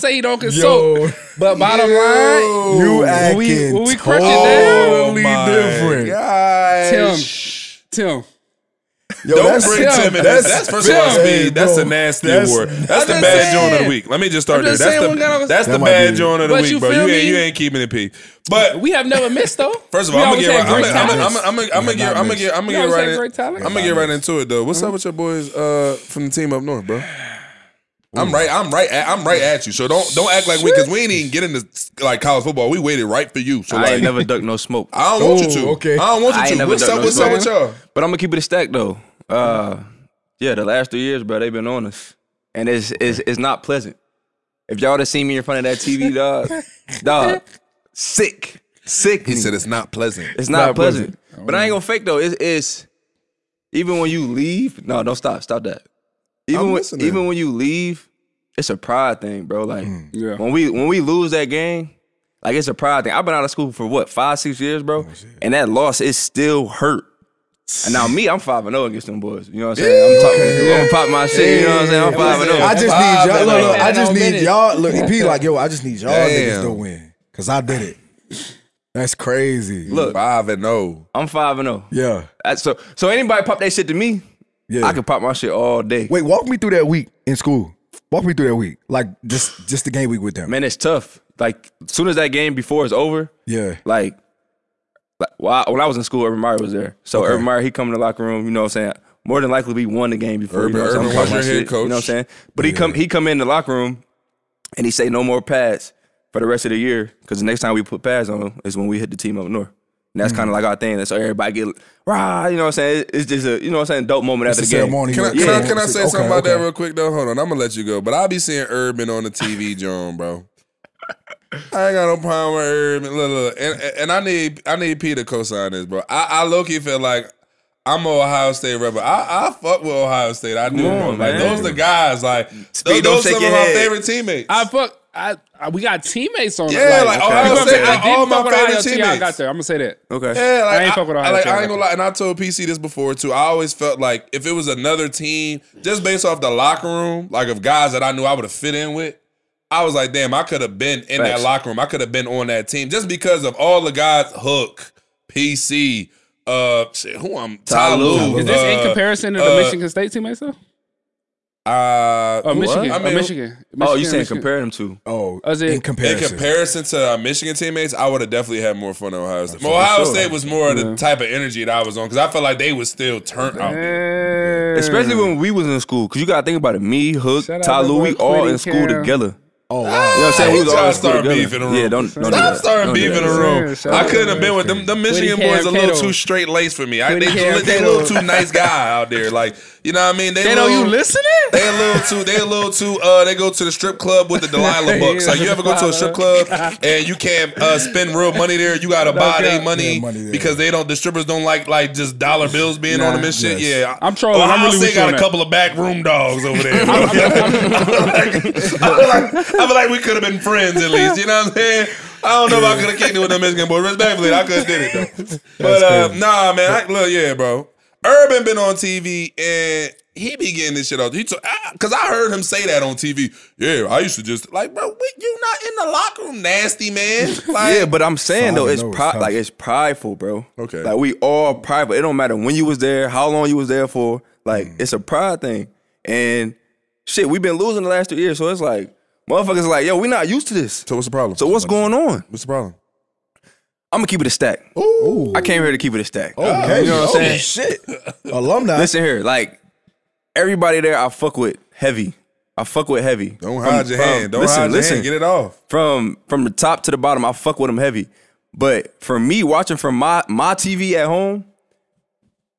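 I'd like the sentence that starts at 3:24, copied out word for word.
Ohio I'm really got a couple of back room dogs over there.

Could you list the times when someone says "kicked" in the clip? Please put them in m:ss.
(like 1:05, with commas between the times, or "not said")
3:32.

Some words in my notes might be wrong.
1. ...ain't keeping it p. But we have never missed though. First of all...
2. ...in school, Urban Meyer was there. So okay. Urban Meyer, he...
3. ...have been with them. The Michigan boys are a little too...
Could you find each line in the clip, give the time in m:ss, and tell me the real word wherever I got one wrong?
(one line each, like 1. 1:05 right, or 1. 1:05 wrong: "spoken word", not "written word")
1. 0:17 right
2. 1:35 right
3. 3:04 right.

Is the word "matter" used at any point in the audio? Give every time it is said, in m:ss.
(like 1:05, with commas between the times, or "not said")
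3:52.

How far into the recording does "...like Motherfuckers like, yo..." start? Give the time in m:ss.
3:58.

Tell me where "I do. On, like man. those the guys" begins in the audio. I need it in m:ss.
2:10.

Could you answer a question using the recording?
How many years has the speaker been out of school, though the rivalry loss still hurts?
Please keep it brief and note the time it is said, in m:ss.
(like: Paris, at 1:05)
5 or 6, at 1:04.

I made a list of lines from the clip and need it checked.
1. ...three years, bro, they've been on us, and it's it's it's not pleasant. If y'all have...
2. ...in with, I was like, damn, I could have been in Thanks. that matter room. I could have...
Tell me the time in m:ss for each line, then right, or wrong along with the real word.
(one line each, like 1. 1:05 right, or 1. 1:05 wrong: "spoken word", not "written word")
1. 0:40 right
2. 2:28 wrong: "locker", not "matter".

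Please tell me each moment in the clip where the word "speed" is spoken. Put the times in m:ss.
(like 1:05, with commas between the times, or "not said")
0:11, 2:12.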